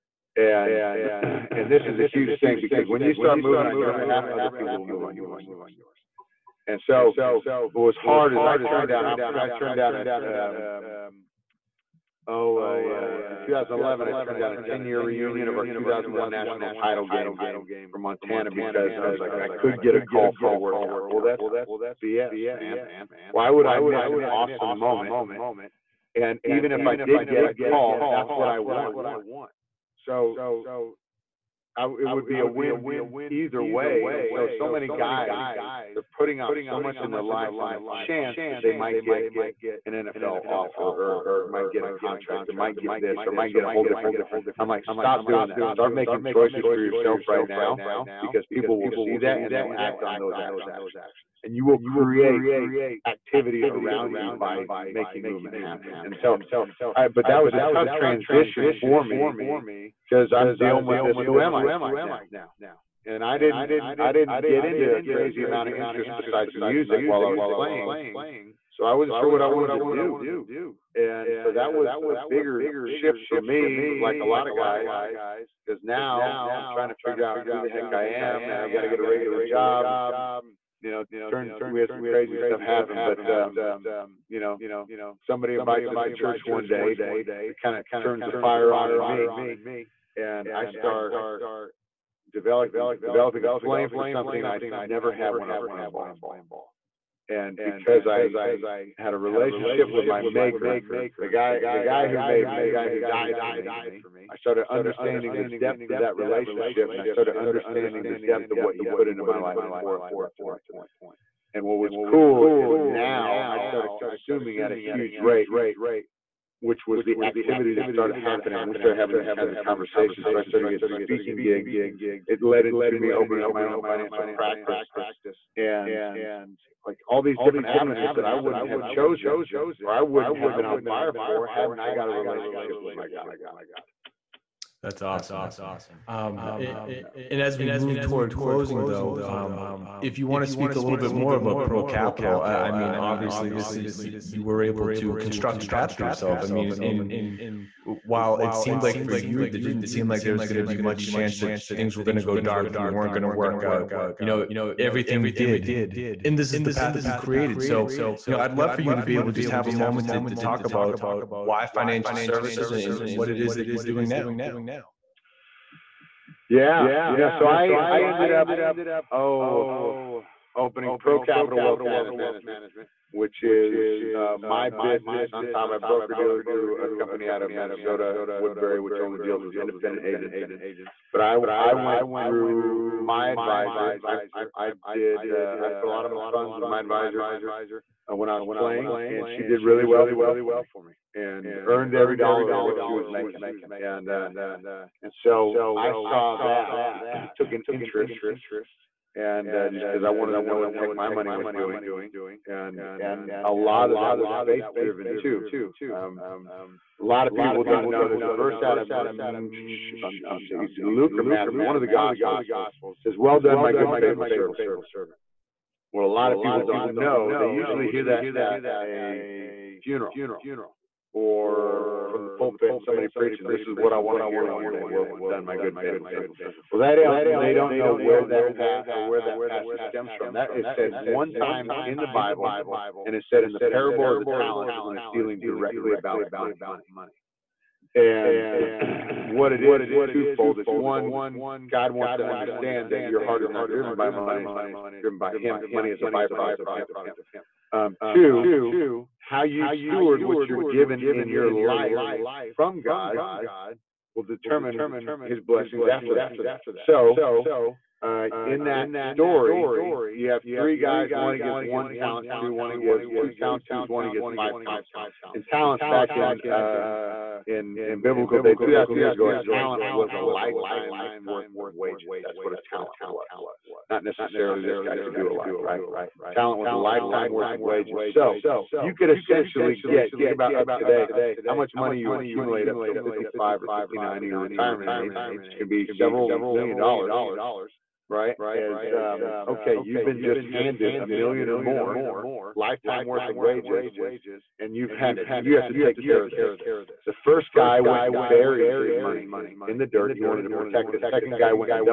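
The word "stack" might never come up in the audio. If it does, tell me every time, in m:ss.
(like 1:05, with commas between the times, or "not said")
not said.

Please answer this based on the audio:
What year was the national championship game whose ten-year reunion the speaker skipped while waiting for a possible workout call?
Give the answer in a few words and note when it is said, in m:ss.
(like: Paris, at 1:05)
2001, at 0:15.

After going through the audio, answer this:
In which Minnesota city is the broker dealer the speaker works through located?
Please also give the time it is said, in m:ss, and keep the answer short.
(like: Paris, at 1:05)
Woodbury, at 2:58.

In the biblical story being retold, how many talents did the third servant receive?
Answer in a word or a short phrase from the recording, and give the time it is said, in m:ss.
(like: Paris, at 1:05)
5, at 4:24.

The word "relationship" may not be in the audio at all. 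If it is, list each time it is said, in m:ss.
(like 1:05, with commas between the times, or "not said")
1:39, 1:46, 2:12.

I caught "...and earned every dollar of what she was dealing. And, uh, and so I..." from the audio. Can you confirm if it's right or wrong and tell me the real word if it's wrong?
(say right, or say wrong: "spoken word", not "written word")
wrong: "making", not "dealing".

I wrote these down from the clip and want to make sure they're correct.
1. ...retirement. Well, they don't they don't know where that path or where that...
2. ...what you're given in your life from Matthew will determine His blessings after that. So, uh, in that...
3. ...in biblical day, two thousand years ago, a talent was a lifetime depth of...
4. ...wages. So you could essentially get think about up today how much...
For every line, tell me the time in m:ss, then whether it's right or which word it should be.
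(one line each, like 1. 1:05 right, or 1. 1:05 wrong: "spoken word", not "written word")
1. 3:46 wrong: "servant", not "retirement"
2. 4:10 wrong: "God", not "Matthew"
3. 4:27 wrong: "worth", not "depth"
4. 4:37 right.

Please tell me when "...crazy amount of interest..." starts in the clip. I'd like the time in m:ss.
1:05.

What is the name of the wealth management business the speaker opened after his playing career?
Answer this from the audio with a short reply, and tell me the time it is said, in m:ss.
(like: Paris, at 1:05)
Pro Capital Wealth Management, at 2:51.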